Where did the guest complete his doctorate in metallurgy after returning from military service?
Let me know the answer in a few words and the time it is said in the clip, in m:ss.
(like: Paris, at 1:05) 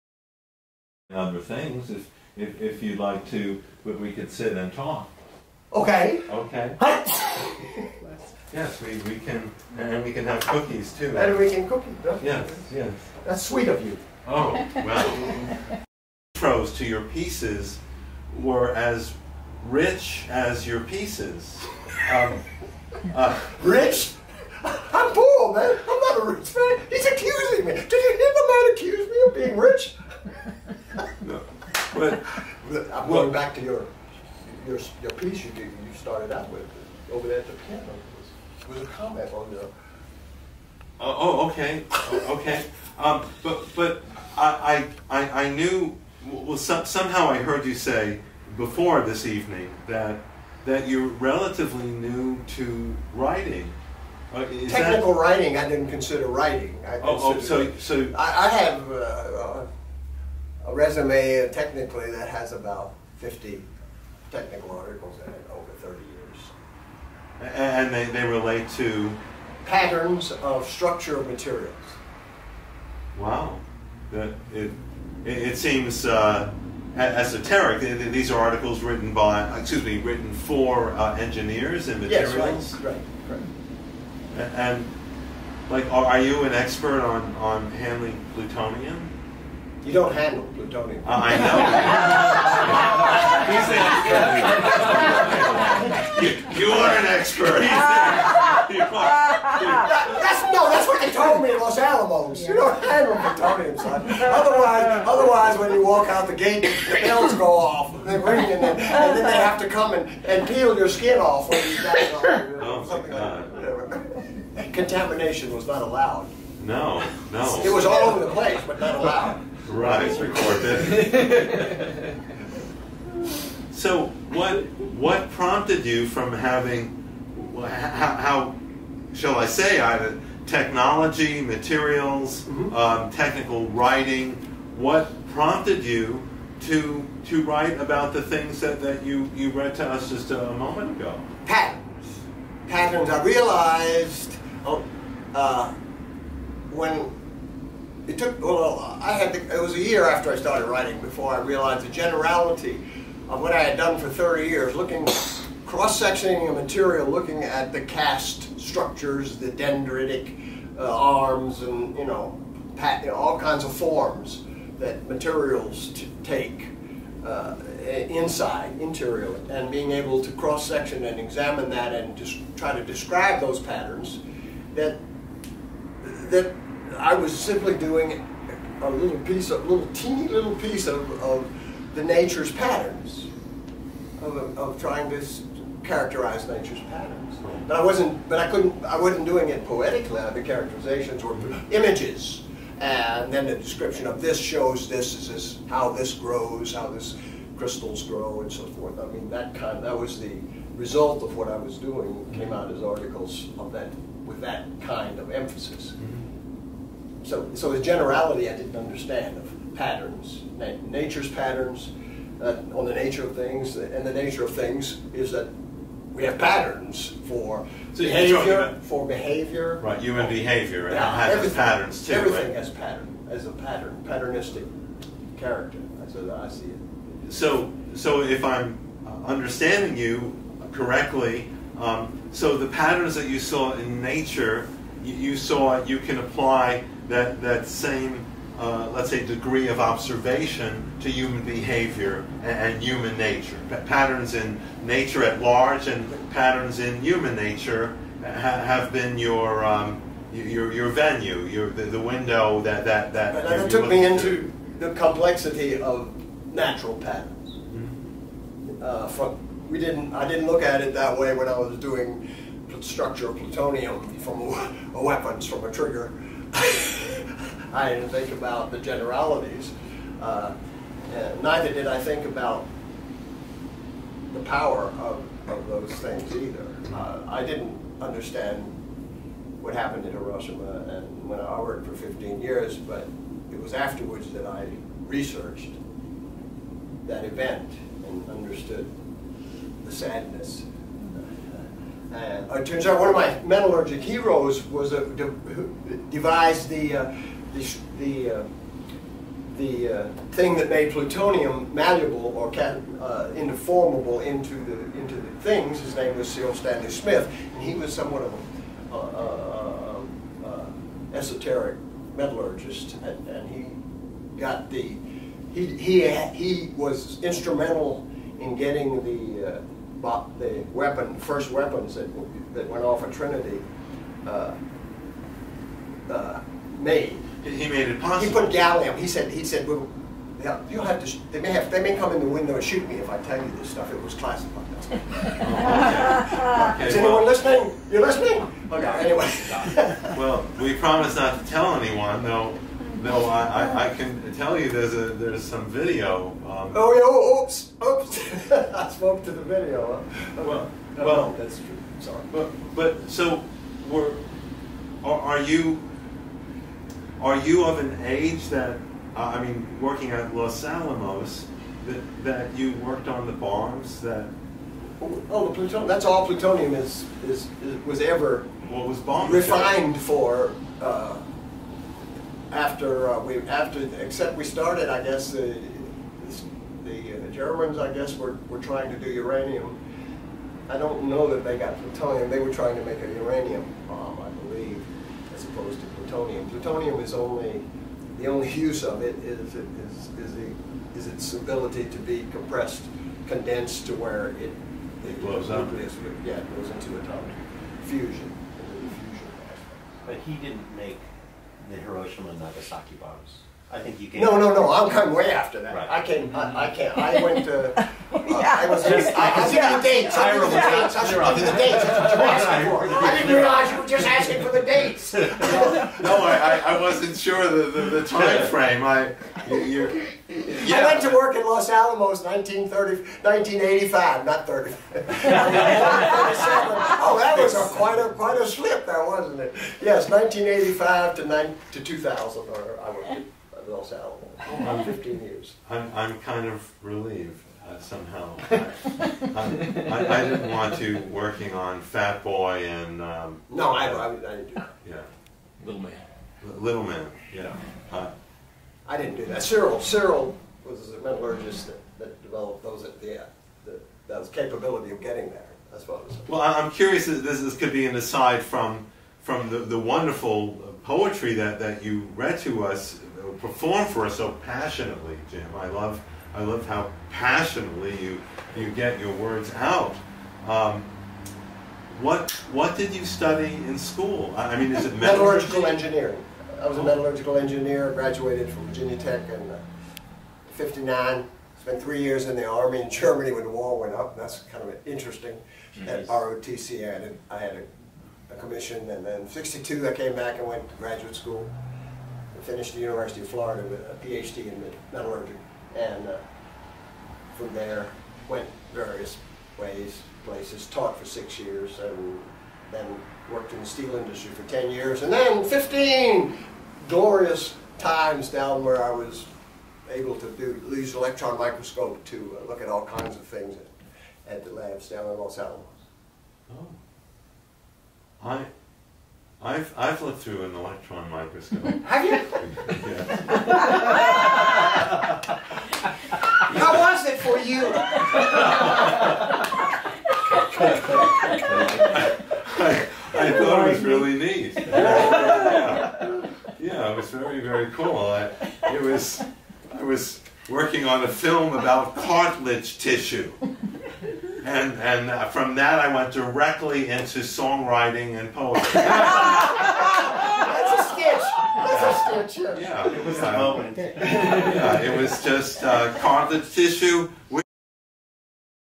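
University of Florida, at 8:12.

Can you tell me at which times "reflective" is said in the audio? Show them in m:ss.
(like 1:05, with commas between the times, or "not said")
not said.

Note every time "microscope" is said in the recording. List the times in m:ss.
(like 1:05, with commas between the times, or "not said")
8:31, 8:41.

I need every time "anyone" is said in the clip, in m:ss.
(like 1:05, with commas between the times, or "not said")
5:36, 5:41.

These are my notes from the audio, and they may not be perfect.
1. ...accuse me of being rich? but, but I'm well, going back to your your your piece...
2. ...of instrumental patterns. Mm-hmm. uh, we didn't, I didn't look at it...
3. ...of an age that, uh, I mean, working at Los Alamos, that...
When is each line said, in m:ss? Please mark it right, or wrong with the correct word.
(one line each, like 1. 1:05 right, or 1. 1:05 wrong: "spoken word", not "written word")
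1. 0:28 right
2. 4:15 wrong: "natural", not "instrumental"
3. 5:57 right.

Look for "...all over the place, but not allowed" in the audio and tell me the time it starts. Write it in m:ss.
1:57.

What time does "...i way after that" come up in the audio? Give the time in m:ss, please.
6:44.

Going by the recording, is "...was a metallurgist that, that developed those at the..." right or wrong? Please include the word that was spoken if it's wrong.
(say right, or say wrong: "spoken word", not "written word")
right.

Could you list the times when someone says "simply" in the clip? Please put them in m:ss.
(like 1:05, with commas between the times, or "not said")
2:57.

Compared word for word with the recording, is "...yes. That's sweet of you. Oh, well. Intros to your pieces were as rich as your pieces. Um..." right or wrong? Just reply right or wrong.
right.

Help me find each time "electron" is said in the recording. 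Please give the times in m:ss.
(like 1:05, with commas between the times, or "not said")
8:30, 8:40.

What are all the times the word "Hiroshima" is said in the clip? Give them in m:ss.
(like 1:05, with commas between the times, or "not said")
4:40, 6:41.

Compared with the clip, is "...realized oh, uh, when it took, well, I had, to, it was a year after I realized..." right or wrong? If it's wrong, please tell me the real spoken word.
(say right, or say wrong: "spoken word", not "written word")
wrong: "started", not "realized".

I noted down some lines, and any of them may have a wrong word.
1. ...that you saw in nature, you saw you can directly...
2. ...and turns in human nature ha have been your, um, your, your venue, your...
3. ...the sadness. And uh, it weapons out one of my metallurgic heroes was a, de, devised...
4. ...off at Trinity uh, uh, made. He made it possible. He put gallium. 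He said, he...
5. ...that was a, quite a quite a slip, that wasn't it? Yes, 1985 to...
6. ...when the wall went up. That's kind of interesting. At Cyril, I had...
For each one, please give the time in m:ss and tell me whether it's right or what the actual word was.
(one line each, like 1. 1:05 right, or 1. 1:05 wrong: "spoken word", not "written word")
1. 3:53 wrong: "apply", not "directly"
2. 4:05 wrong: "patterns", not "turns"
3. 4:49 wrong: "turns", not "weapons"
4. 5:22 right
5. 7:07 right
6. 8:03 wrong: "ROTC", not "Cyril".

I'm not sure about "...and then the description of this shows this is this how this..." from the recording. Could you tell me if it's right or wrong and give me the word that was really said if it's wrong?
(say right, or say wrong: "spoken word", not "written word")
right.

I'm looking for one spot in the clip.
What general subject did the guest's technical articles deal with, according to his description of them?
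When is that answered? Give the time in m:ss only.
1:09.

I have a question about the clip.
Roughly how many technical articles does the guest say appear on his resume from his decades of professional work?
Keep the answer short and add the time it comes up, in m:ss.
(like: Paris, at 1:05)
50, at 1:02.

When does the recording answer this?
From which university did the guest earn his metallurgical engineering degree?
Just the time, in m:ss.
7:58.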